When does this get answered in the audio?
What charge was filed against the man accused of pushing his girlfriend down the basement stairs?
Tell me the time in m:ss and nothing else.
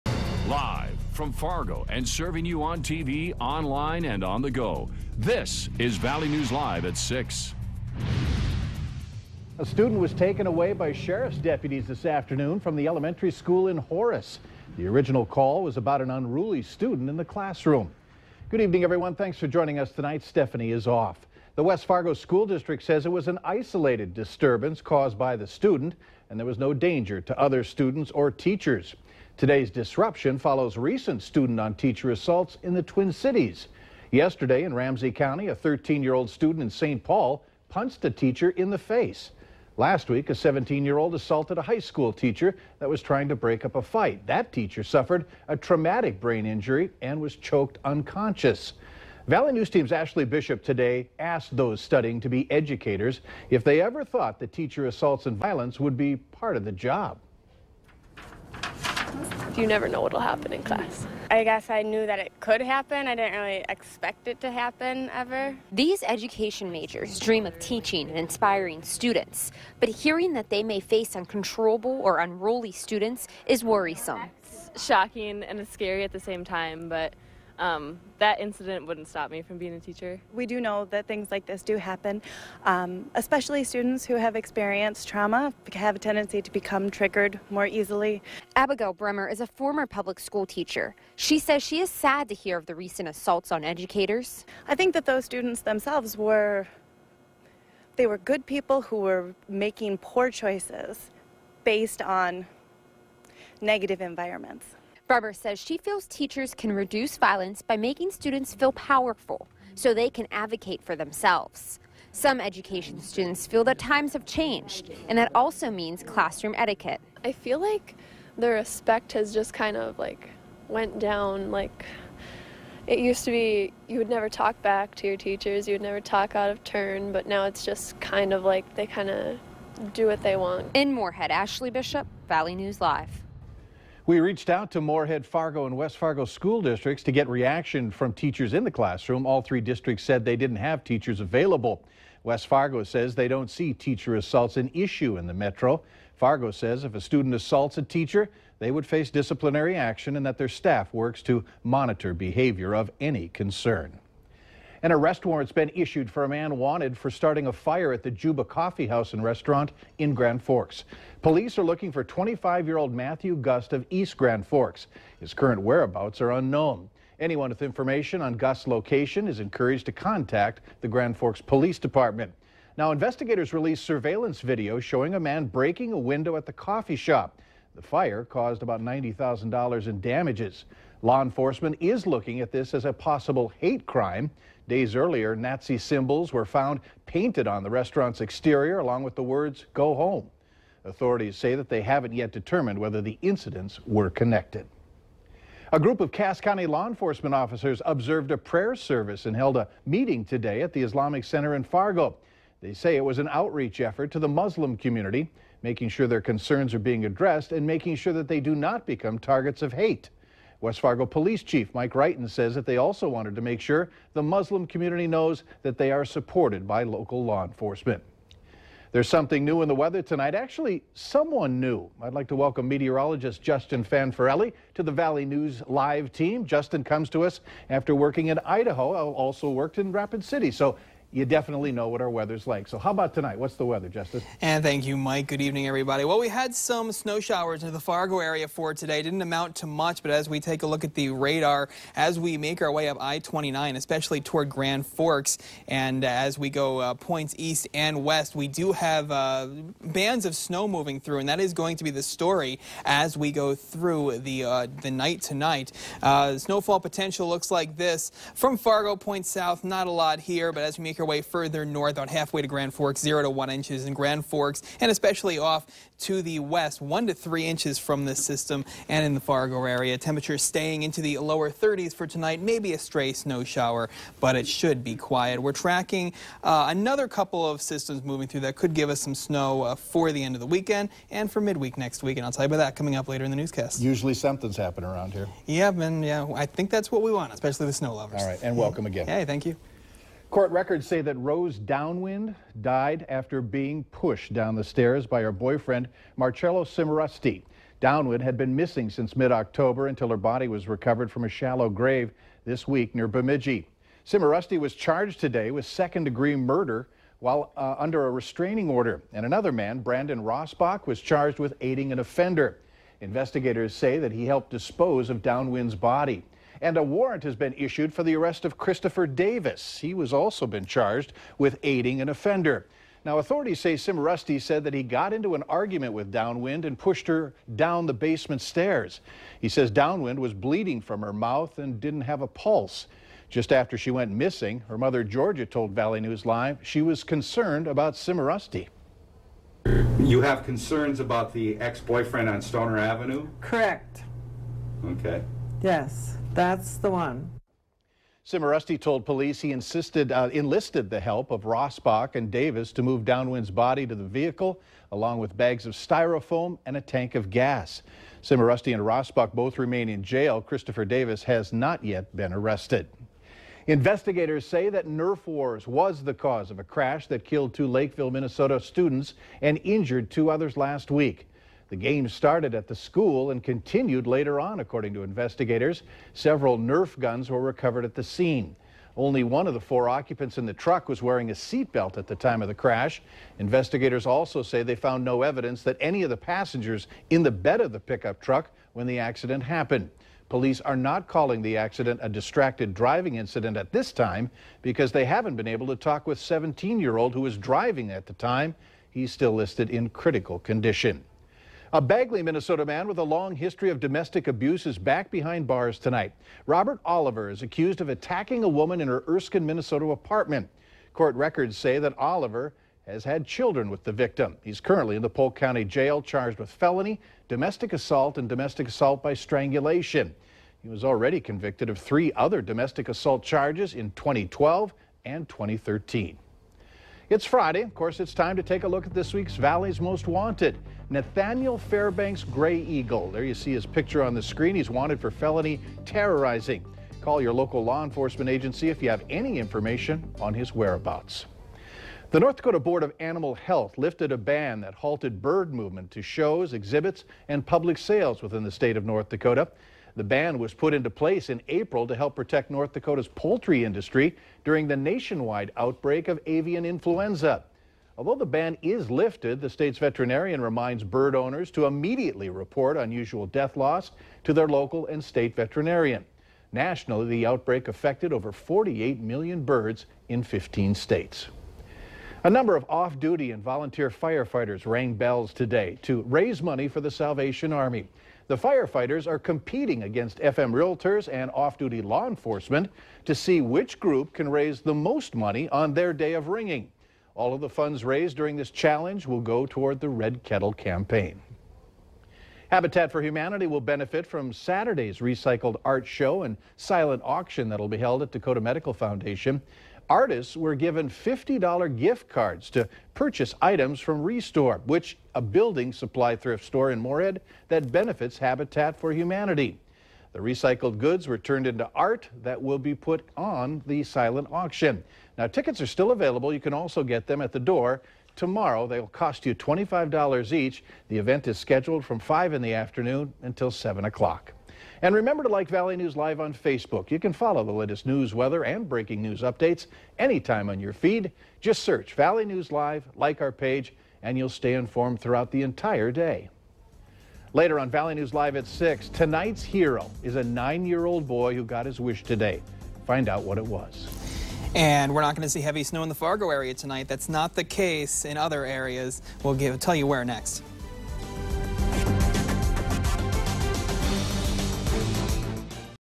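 5:05.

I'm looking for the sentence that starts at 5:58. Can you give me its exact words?
Cimarusti and Rossbach both remain in jail.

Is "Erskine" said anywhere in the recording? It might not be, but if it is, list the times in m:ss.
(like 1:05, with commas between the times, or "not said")
6:49.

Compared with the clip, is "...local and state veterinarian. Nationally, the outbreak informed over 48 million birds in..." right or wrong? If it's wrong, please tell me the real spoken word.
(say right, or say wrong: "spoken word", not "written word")
wrong: "affected", not "informed".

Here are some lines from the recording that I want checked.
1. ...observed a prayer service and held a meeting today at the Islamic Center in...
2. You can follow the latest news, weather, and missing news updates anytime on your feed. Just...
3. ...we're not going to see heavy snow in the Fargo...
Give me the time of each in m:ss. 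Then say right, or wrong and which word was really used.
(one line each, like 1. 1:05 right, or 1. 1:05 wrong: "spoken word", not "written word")
1. 3:17 right
2. 8:46 wrong: "breaking", not "missing"
3. 9:04 right.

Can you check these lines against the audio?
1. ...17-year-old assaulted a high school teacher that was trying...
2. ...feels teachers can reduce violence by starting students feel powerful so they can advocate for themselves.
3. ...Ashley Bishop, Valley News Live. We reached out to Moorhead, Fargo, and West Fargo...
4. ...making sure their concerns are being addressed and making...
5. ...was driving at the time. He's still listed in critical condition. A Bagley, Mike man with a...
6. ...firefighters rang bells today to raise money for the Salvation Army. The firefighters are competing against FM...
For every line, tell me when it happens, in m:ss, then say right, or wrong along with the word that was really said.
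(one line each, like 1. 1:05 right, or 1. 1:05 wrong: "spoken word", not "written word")
1. 0:40 right
2. 1:45 wrong: "making", not "starting"
3. 2:11 right
4. 3:25 right
5. 6:37 wrong: "Minnesota", not "Mike"
6. 7:53 right.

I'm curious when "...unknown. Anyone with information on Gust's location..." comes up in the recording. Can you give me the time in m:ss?
2:46.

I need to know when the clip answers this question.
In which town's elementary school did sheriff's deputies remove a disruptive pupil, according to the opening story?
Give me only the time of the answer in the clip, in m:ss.
0:13.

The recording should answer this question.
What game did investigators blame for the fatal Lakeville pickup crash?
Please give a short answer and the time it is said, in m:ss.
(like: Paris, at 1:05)
Nerf wars, at 6:04.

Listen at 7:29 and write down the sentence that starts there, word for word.
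The ban was put into place in April to help protect North Dakota's poultry industry during the nationwide outbreak of avian influenza.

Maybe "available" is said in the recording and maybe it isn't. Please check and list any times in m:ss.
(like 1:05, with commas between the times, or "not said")
2:21, 8:35.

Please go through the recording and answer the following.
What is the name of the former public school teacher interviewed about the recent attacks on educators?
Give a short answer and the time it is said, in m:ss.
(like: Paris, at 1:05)
Abigail Bremer, at 1:28.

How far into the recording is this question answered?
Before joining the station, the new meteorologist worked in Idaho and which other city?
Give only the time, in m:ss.
3:49.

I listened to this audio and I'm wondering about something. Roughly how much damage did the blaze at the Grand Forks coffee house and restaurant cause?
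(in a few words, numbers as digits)
$90,000.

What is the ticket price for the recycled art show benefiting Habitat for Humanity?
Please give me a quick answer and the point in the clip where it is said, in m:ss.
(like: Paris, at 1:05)
$25, at 8:39.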